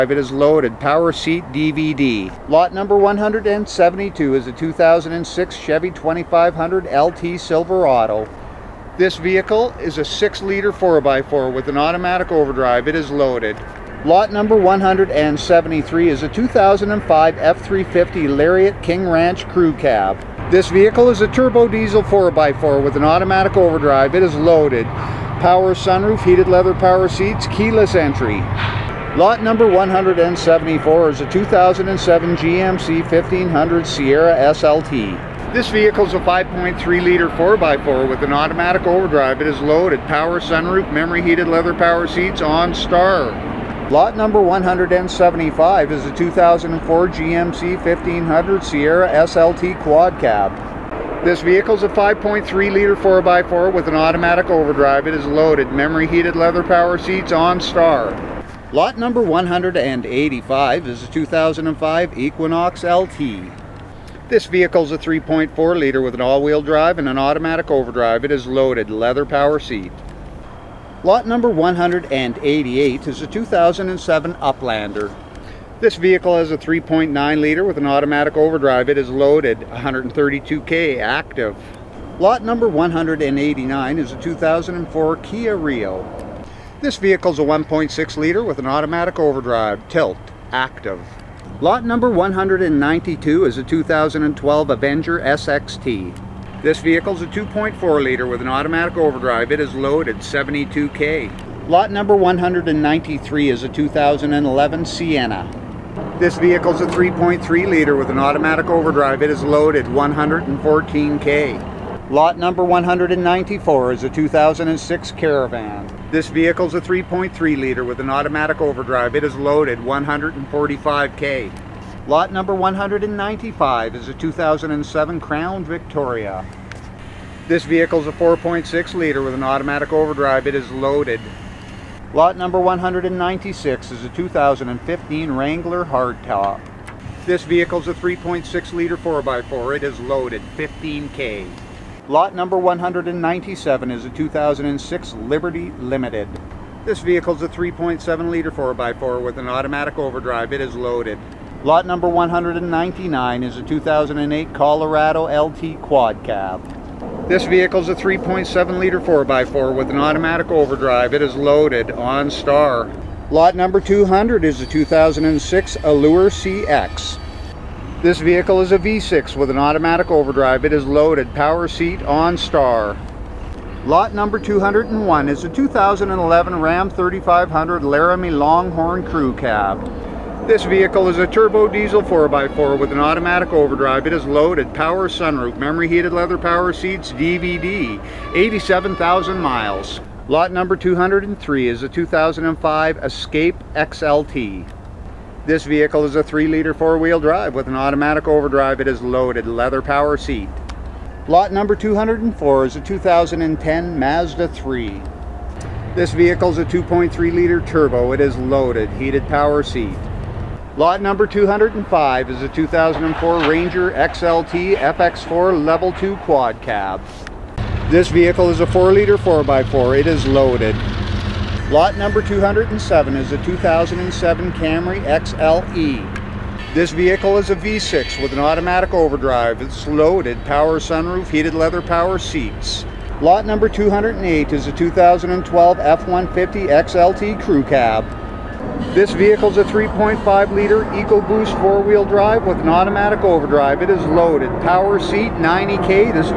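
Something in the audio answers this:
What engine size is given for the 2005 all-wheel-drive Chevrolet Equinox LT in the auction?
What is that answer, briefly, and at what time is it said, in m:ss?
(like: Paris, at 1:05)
3.4 liter, at 1:04.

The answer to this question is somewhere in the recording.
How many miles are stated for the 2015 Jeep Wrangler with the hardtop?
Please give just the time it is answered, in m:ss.
2:20.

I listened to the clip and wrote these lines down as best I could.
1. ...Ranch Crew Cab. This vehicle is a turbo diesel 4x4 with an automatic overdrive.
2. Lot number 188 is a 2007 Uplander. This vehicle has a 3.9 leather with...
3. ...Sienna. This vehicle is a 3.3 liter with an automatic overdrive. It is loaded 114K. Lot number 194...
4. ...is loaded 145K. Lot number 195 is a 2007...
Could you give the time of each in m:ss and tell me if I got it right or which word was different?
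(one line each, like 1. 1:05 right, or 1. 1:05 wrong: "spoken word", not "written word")
1. 0:19 right
2. 1:11 wrong: "liter", not "leather"
3. 1:44 right
4. 1:59 right.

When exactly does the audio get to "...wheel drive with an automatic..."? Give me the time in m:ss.
3:16.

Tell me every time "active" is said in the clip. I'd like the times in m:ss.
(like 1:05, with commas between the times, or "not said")
1:20, 1:30.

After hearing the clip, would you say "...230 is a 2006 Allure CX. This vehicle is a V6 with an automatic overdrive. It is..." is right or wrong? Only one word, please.
wrong.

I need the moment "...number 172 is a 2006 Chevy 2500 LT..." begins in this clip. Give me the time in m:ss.
0:02.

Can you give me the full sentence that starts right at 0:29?
Lot number 174 is a 2007 GMC 1500 Sierra SLT.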